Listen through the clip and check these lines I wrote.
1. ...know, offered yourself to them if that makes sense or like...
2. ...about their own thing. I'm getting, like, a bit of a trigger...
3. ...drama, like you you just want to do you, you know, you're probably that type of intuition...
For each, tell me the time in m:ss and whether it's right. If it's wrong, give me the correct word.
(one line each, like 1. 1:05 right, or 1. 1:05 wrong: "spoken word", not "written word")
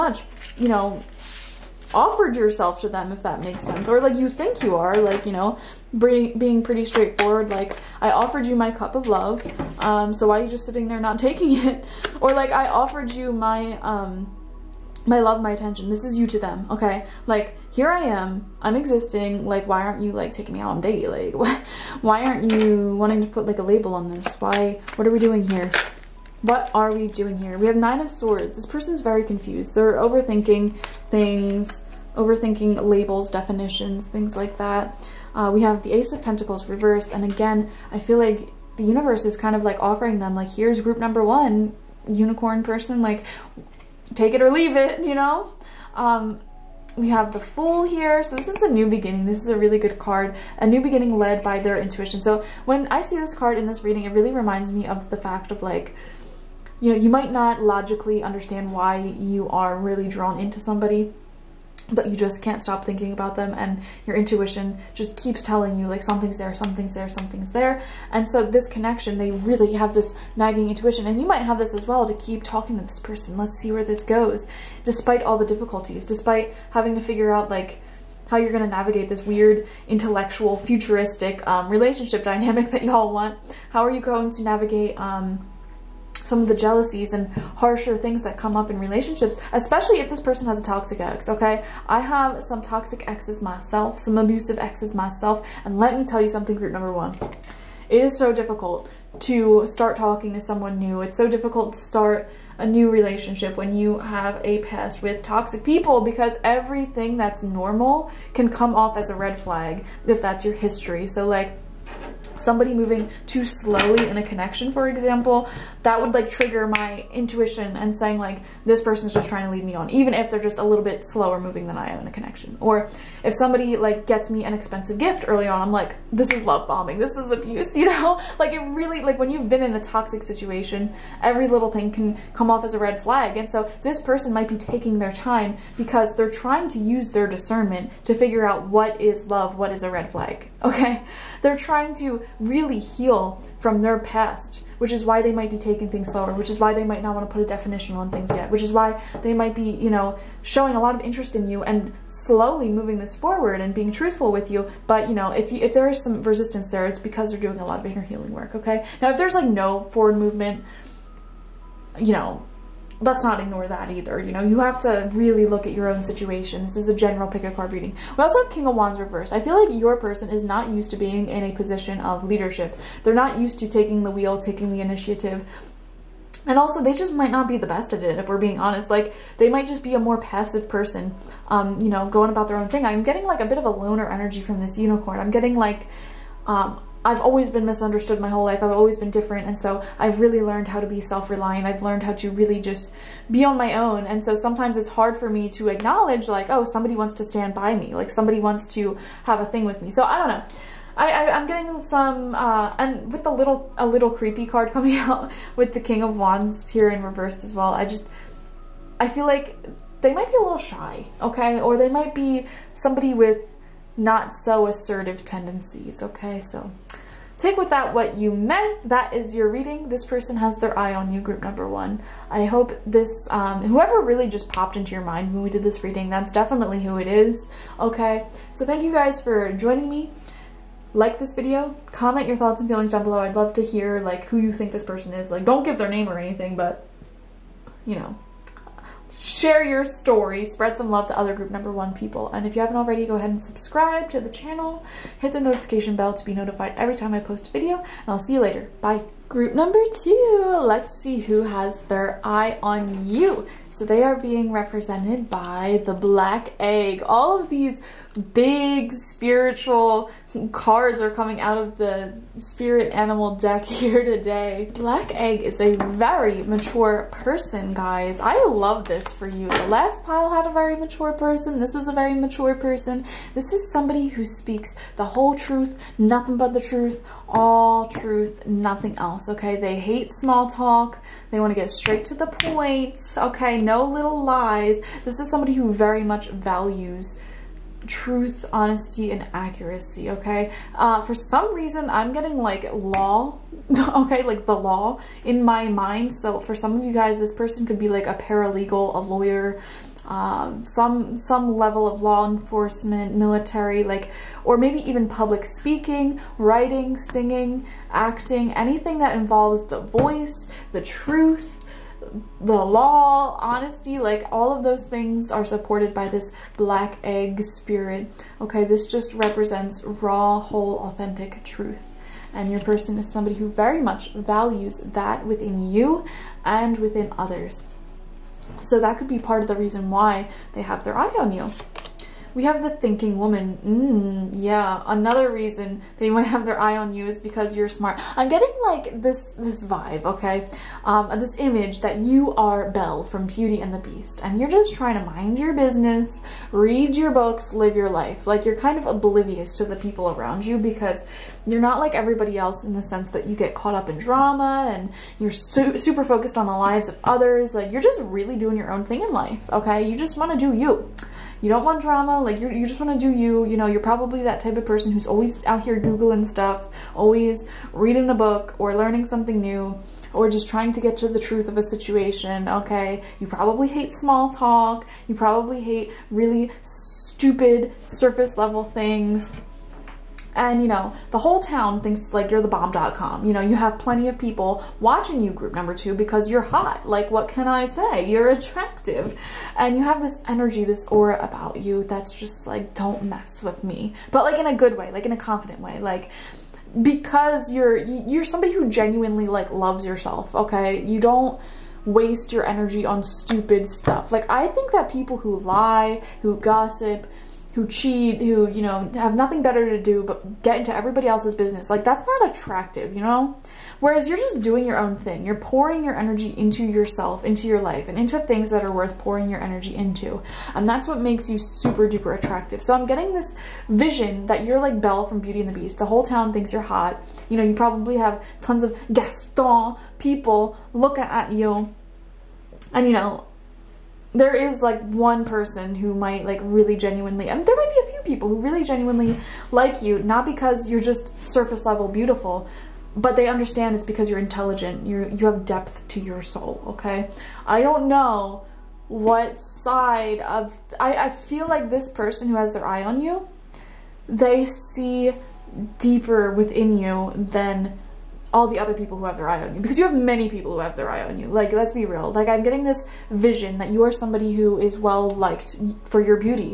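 1. 0:00 right
2. 3:02 wrong: "loner", not "trigger"
3. 6:01 wrong: "person", not "intuition".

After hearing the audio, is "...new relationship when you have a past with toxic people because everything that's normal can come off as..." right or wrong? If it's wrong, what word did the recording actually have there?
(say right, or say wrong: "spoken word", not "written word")
right.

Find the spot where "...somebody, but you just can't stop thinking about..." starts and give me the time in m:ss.
1:00.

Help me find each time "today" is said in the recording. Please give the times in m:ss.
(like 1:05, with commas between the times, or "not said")
4:24.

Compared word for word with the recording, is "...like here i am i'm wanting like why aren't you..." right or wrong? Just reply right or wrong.
wrong.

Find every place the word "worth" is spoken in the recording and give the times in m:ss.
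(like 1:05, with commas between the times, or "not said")
6:58.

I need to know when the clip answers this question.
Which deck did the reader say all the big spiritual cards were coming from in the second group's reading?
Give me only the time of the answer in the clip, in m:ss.
4:22.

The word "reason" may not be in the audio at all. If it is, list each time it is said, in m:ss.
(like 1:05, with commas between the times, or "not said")
4:51, 5:29, 5:35.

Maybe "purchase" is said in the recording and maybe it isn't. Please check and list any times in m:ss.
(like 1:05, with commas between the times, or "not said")
not said.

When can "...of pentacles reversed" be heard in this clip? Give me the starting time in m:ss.
0:36.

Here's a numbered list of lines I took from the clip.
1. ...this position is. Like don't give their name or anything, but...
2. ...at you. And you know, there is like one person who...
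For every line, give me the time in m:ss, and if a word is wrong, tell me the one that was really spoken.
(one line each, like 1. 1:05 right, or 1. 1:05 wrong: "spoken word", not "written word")
1. 3:54 wrong: "person", not "position"
2. 7:11 right.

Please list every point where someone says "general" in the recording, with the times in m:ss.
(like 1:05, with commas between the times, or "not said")
2:46.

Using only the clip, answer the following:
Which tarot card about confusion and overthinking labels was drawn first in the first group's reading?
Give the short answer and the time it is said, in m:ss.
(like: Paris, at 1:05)
Nine of Swords, at 0:27.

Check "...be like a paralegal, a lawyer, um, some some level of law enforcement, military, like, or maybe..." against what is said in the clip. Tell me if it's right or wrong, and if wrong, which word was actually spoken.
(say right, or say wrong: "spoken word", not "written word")
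right.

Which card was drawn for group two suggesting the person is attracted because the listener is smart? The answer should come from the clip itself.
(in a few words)
The Thinking Woman.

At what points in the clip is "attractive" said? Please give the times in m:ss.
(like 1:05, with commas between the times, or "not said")
6:28, 6:52, 7:02.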